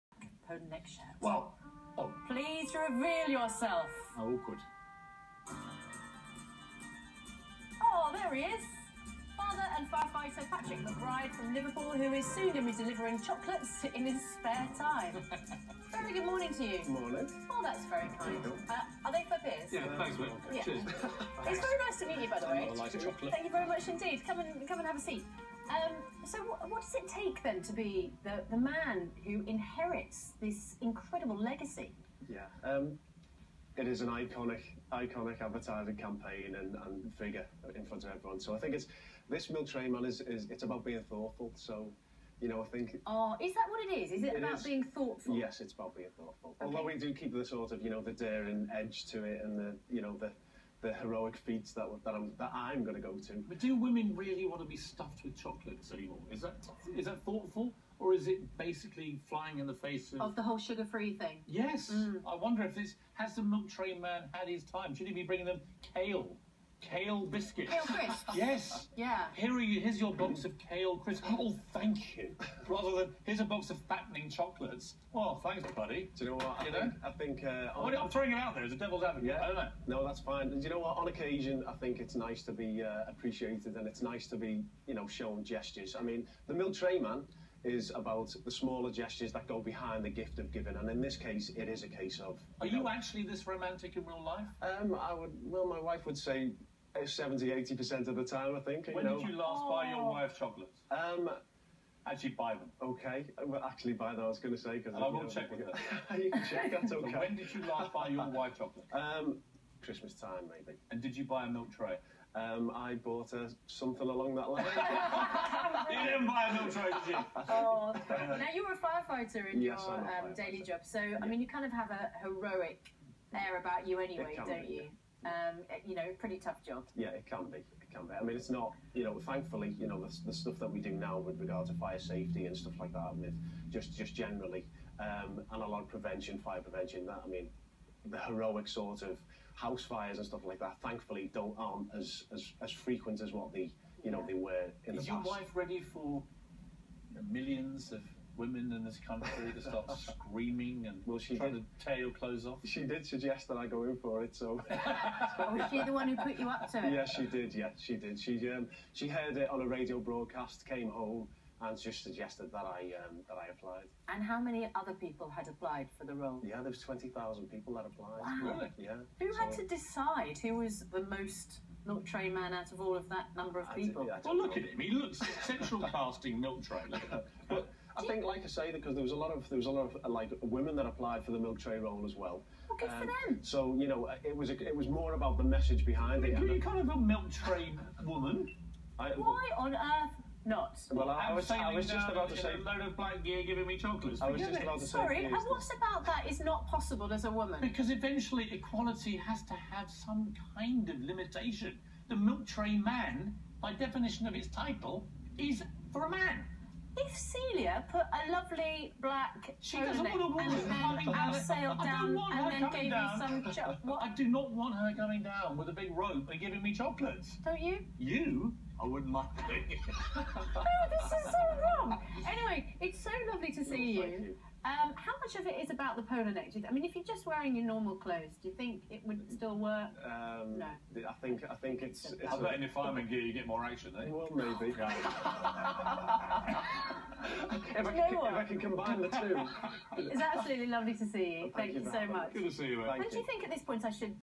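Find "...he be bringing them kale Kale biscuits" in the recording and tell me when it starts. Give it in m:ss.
1:05.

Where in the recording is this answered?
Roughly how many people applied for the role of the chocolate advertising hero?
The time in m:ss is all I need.
2:46.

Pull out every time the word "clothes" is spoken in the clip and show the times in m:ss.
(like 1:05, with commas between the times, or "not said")
2:32, 3:47.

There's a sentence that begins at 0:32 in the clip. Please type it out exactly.
Yeah, um, it is an iconic, iconic advertising campaign and, and figure in front of everyone.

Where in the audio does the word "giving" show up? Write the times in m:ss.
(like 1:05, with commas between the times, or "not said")
1:30, 3:13, 3:36.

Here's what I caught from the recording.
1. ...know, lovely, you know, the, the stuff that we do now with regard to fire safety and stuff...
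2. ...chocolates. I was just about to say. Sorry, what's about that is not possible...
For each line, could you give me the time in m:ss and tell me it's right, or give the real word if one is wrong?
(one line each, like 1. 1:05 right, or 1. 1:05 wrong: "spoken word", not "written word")
1. 2:09 wrong: "thankfully", not "lovely"
2. 3:13 right.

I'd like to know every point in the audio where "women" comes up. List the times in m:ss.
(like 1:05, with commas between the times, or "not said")
0:53, 2:28, 3:00.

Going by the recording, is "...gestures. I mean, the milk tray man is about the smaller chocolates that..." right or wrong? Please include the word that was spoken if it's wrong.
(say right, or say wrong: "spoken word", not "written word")
wrong: "gestures", not "chocolates".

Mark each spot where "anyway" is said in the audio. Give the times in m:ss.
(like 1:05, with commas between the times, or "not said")
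2:03, 3:42.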